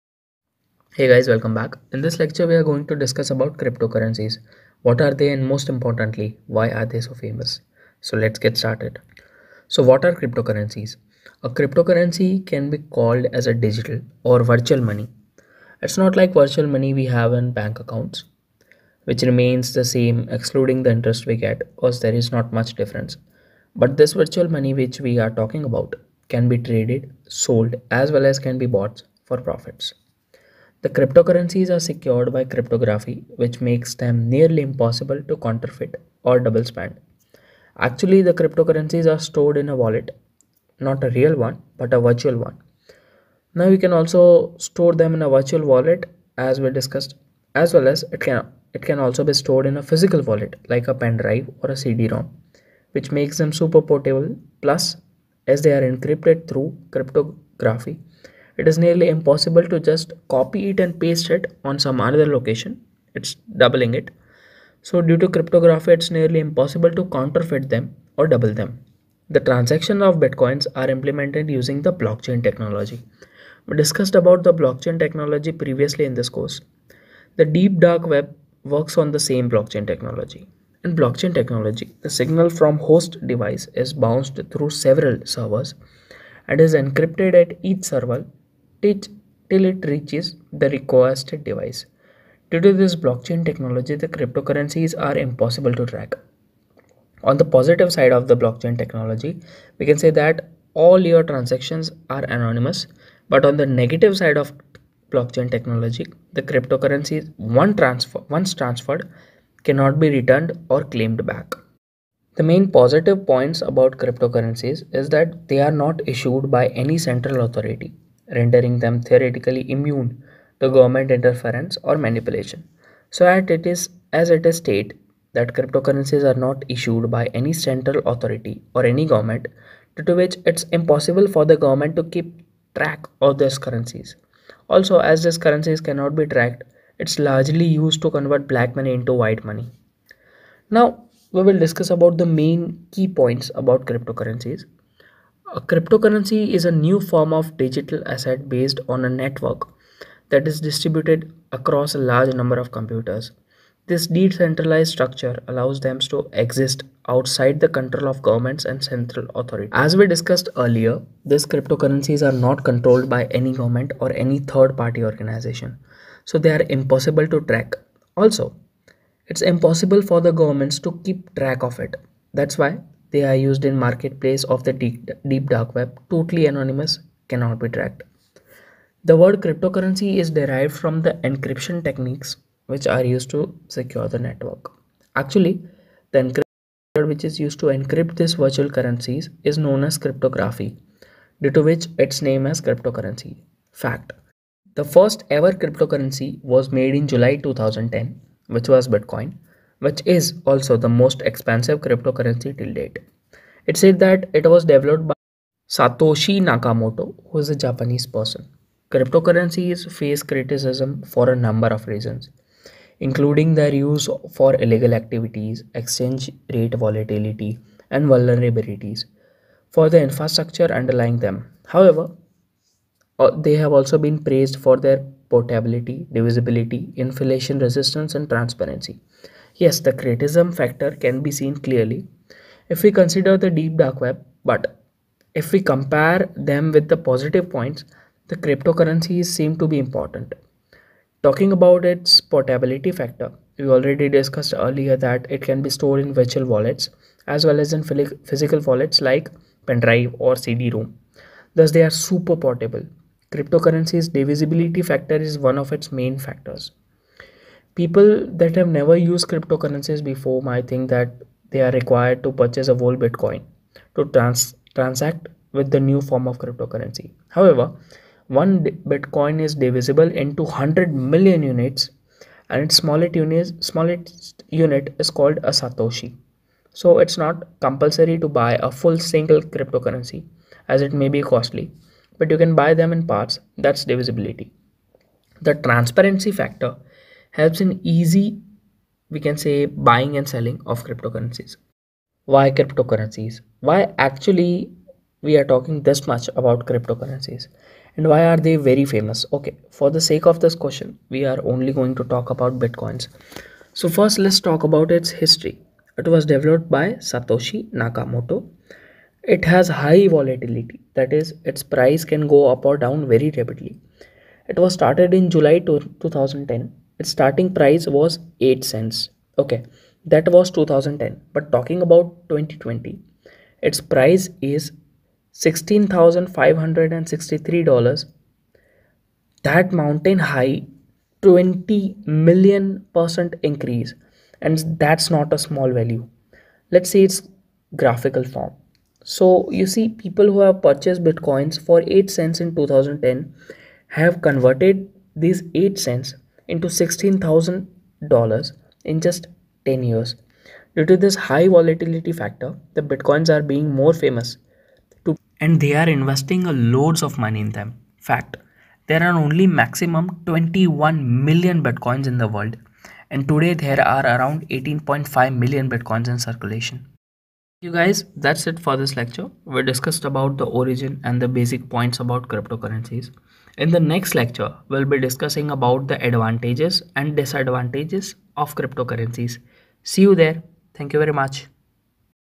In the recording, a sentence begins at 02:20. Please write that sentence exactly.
Now, we will discuss about the main key points about cryptocurrencies.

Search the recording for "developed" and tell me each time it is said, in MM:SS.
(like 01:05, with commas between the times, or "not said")
03:24, 05:06.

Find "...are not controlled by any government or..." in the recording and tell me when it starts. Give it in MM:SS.
02:42.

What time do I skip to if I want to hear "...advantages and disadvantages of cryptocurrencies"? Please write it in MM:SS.
06:16.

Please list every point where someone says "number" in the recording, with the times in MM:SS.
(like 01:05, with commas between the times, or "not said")
02:32, 03:31.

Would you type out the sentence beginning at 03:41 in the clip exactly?
However, uh, they have also been praised for their portability, divisibility, inflation resistance, and transparency.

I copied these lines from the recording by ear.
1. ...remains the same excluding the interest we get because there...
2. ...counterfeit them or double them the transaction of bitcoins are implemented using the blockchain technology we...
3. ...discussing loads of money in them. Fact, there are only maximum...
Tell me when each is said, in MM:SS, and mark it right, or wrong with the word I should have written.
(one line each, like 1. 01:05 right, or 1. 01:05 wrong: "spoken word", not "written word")
1. 00:19 right
2. 01:07 right
3. 05:55 wrong: "investing", not "discussing".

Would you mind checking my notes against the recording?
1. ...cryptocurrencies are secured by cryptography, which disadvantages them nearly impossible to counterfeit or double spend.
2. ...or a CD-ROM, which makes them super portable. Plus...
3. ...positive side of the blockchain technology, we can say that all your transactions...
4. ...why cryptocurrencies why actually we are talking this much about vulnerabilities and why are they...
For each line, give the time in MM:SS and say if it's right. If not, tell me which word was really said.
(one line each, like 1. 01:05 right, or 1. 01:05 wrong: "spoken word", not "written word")
1. 00:30 wrong: "makes", not "disadvantages"
2. 00:51 right
3. 01:37 right
4. 04:52 wrong: "cryptocurrencies", not "vulnerabilities".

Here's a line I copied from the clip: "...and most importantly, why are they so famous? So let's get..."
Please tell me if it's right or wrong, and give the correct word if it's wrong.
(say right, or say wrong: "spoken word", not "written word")
right.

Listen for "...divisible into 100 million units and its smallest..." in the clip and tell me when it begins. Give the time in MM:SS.
04:29.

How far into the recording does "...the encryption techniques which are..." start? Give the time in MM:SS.
03:01.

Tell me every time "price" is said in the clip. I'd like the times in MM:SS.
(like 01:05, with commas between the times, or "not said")
05:11, 05:17, 05:23.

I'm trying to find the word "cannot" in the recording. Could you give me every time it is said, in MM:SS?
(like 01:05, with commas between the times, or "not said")
01:49, 02:15, 02:57.